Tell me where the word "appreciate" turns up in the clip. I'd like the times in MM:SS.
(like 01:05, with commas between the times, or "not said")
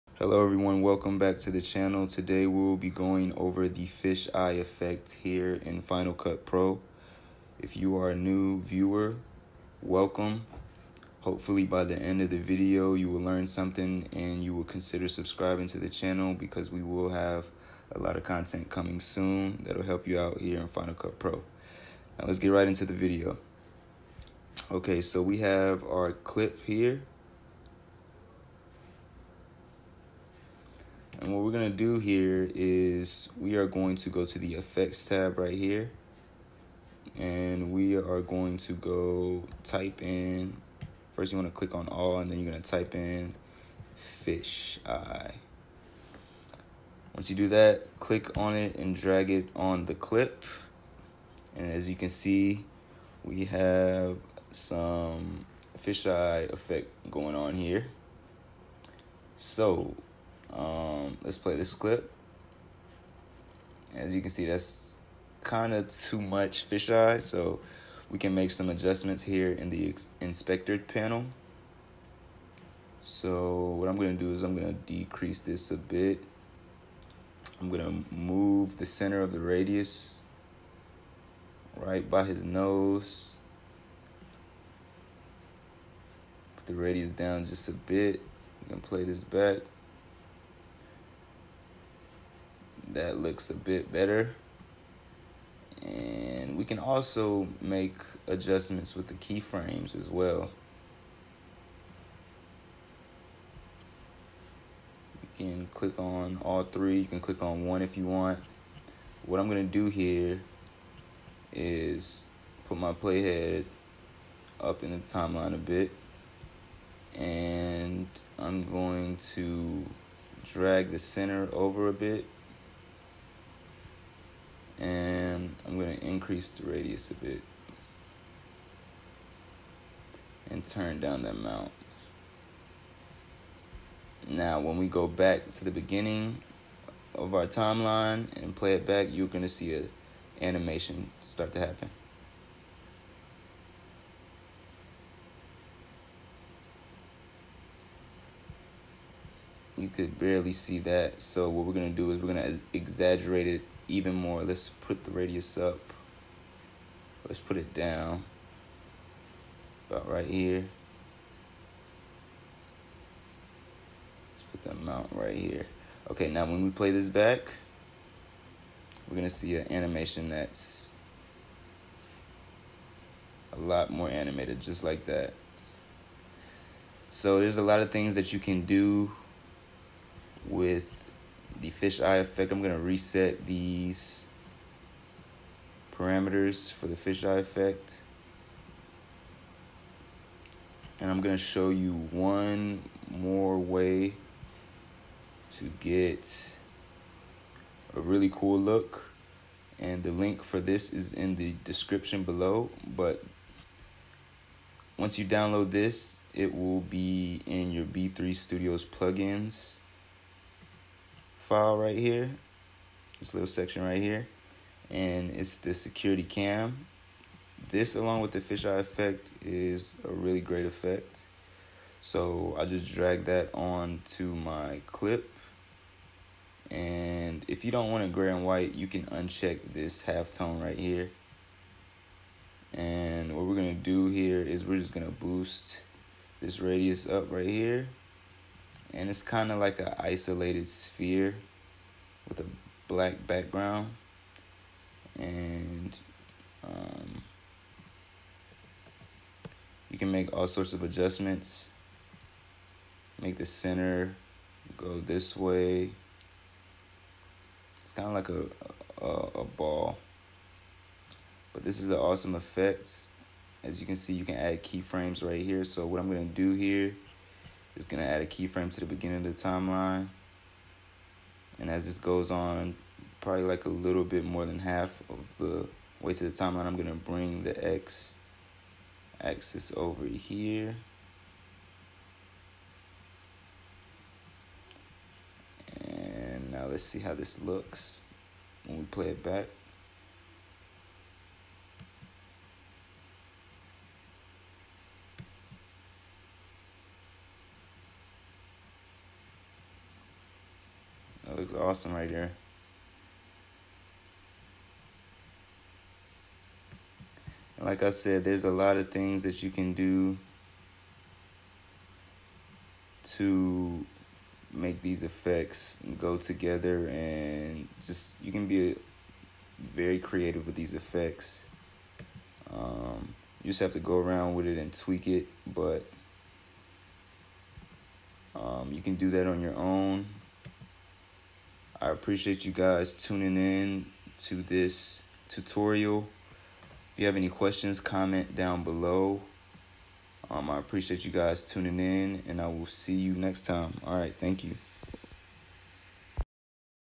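05:31, 05:40.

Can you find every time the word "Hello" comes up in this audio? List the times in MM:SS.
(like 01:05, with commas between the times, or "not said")
00:00.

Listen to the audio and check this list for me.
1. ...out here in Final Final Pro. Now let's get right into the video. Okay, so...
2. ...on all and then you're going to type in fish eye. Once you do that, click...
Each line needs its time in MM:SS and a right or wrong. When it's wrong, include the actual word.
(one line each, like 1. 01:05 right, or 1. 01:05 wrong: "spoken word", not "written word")
1. 00:20 wrong: "Cut", not "Final"
2. 00:41 right.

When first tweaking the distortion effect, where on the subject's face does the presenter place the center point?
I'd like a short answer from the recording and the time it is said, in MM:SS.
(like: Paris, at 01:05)
his nose, at 01:22.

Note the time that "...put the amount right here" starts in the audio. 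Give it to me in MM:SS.
02:44.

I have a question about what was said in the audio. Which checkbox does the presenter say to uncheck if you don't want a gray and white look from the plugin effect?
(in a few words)
halftone.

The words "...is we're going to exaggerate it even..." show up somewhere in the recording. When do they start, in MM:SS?
02:32.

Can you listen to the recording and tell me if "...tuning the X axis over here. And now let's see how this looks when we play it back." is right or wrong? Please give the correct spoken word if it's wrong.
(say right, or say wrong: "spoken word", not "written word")
wrong: "bring", not "tuning".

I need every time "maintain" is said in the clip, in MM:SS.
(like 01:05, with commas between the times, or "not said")
not said.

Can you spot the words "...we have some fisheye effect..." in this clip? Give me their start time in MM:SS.
00:53.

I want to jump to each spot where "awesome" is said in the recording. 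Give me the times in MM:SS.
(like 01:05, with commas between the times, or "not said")
04:21, 05:01.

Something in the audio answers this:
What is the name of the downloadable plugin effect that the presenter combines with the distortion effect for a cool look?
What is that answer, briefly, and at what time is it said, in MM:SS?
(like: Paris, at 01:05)
security cam, at 03:35.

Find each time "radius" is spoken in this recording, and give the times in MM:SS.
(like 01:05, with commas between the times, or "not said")
01:19, 01:26, 02:06, 02:35, 03:56.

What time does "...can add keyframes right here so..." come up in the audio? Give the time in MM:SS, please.
04:24.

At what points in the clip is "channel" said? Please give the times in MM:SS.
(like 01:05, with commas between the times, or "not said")
00:01, 00:15.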